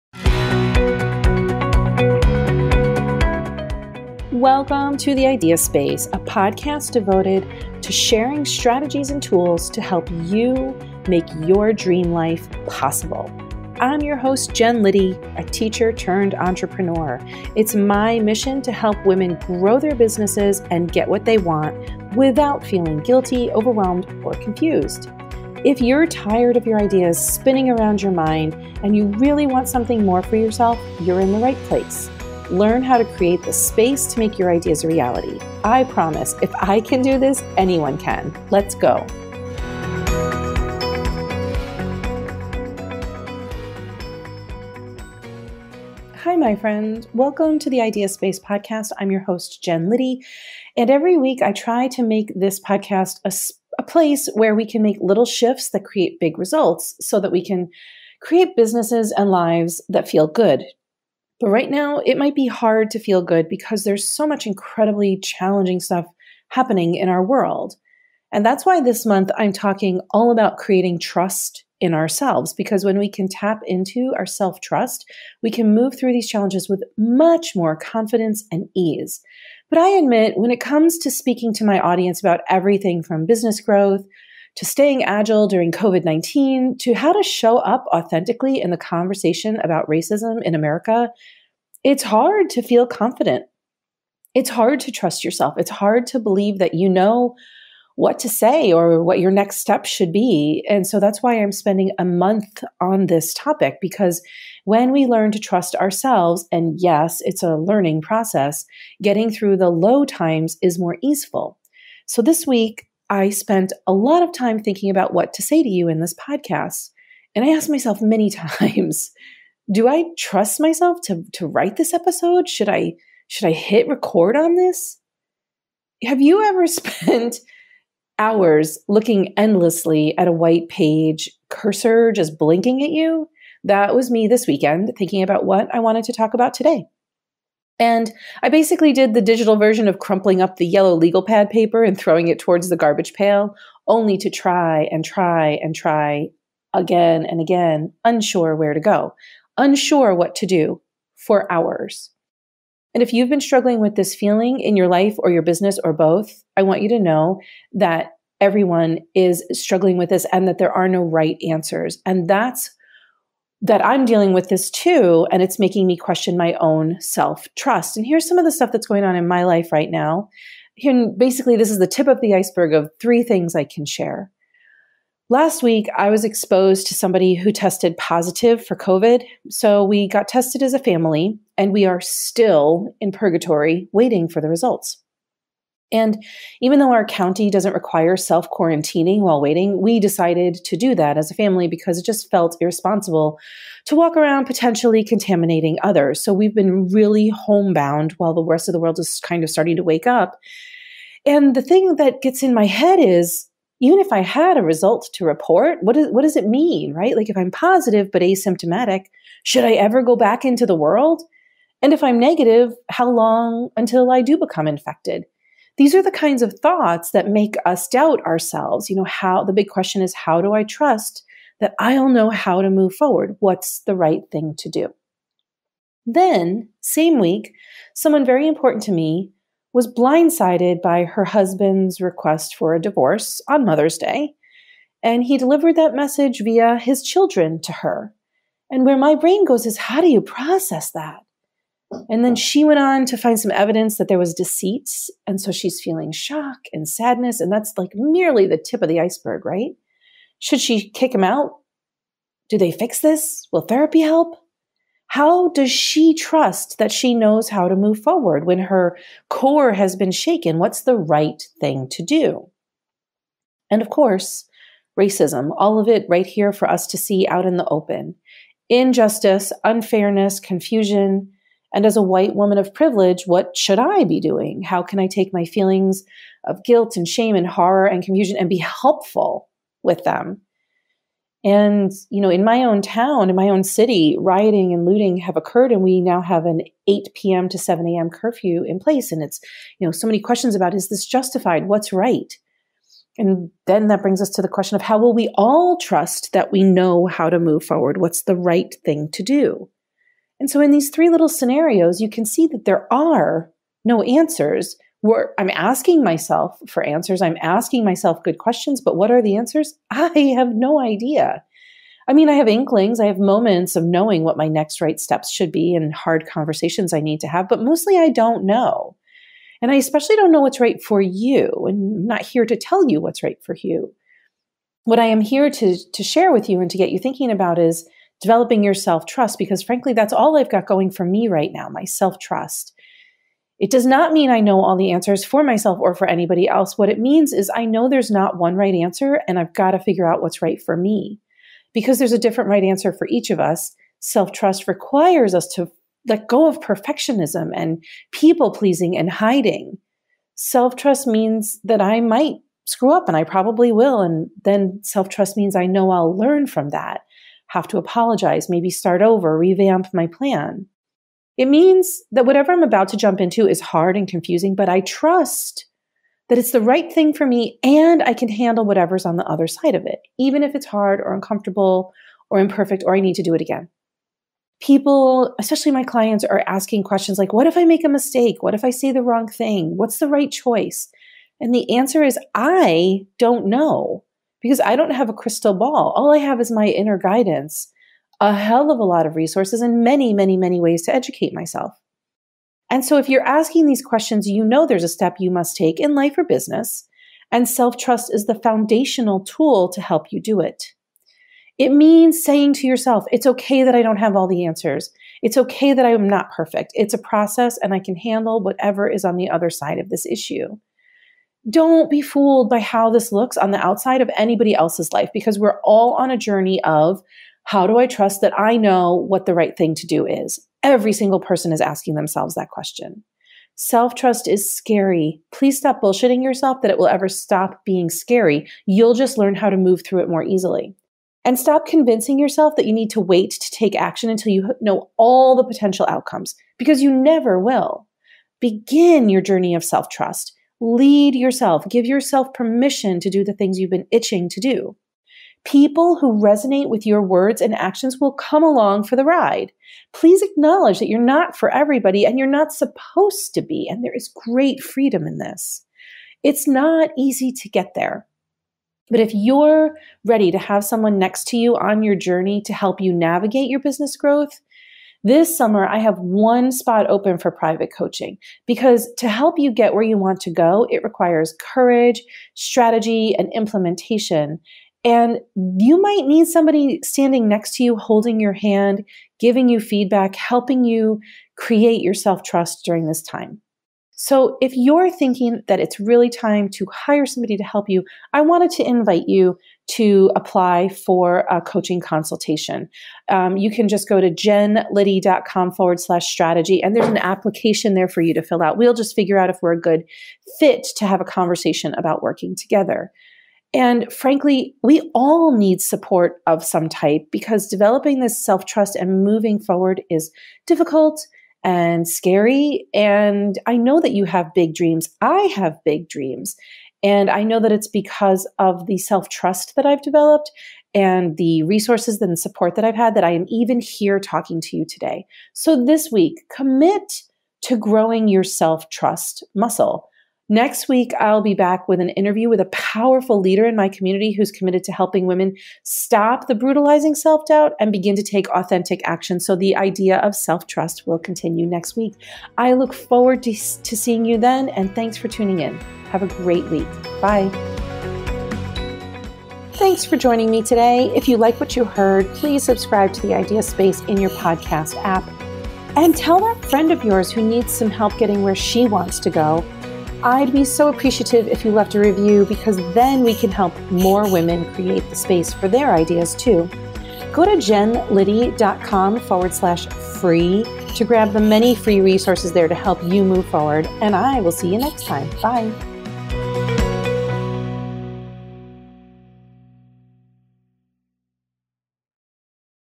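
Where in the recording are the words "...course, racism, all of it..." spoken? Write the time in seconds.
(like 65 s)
263 s.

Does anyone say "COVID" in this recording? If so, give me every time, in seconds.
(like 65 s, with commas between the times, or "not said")
85 s, 178 s.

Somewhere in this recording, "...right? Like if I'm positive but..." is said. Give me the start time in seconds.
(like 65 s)
206 s.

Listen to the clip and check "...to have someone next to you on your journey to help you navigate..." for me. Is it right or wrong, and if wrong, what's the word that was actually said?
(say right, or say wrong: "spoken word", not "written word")
right.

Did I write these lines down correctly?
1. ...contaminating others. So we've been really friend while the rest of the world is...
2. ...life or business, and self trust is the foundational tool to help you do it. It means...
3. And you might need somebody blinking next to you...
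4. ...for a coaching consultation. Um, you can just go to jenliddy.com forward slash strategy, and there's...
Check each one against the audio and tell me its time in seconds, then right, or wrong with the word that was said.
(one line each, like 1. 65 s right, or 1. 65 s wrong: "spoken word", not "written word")
1. 195 s wrong: "homebound", not "friend"
2. 395 s right
3. 474 s wrong: "standing", not "blinking"
4. 490 s right.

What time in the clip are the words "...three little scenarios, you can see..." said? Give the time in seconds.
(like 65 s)
300 s.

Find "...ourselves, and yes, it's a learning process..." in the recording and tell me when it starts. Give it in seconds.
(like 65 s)
105 s.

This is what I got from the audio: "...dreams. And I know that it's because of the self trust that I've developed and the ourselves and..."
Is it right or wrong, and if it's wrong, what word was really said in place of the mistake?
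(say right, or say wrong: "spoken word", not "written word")
wrong: "resources", not "ourselves".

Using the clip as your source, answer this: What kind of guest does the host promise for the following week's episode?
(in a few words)
A powerful leader.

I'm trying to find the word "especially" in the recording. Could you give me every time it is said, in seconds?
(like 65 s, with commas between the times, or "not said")
319 s, 375 s.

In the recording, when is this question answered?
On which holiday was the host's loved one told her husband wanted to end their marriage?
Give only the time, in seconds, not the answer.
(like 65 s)
233 s.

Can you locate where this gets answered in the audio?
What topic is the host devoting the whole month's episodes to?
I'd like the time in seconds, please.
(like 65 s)
70 s.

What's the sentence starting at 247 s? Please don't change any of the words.
And that's like merely the tip of the iceberg, right?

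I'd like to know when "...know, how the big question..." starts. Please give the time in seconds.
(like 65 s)
218 s.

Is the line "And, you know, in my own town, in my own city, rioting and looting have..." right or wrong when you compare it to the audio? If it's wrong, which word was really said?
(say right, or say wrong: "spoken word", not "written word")
right.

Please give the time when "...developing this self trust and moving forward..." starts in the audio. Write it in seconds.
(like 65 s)
507 s.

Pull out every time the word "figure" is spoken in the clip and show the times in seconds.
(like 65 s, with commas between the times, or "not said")
339 s, 498 s.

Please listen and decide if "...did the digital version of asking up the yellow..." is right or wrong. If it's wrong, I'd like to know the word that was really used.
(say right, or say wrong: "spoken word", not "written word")
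wrong: "crumpling", not "asking".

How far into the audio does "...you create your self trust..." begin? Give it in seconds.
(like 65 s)
480 s.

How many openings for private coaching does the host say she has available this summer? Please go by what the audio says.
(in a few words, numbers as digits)
1.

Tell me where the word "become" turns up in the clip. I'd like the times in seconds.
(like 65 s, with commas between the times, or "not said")
214 s.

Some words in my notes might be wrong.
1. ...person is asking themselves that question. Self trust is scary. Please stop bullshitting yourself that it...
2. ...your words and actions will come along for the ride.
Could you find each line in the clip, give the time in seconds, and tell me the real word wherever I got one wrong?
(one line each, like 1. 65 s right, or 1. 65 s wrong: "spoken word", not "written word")
1. 421 s right
2. 446 s right.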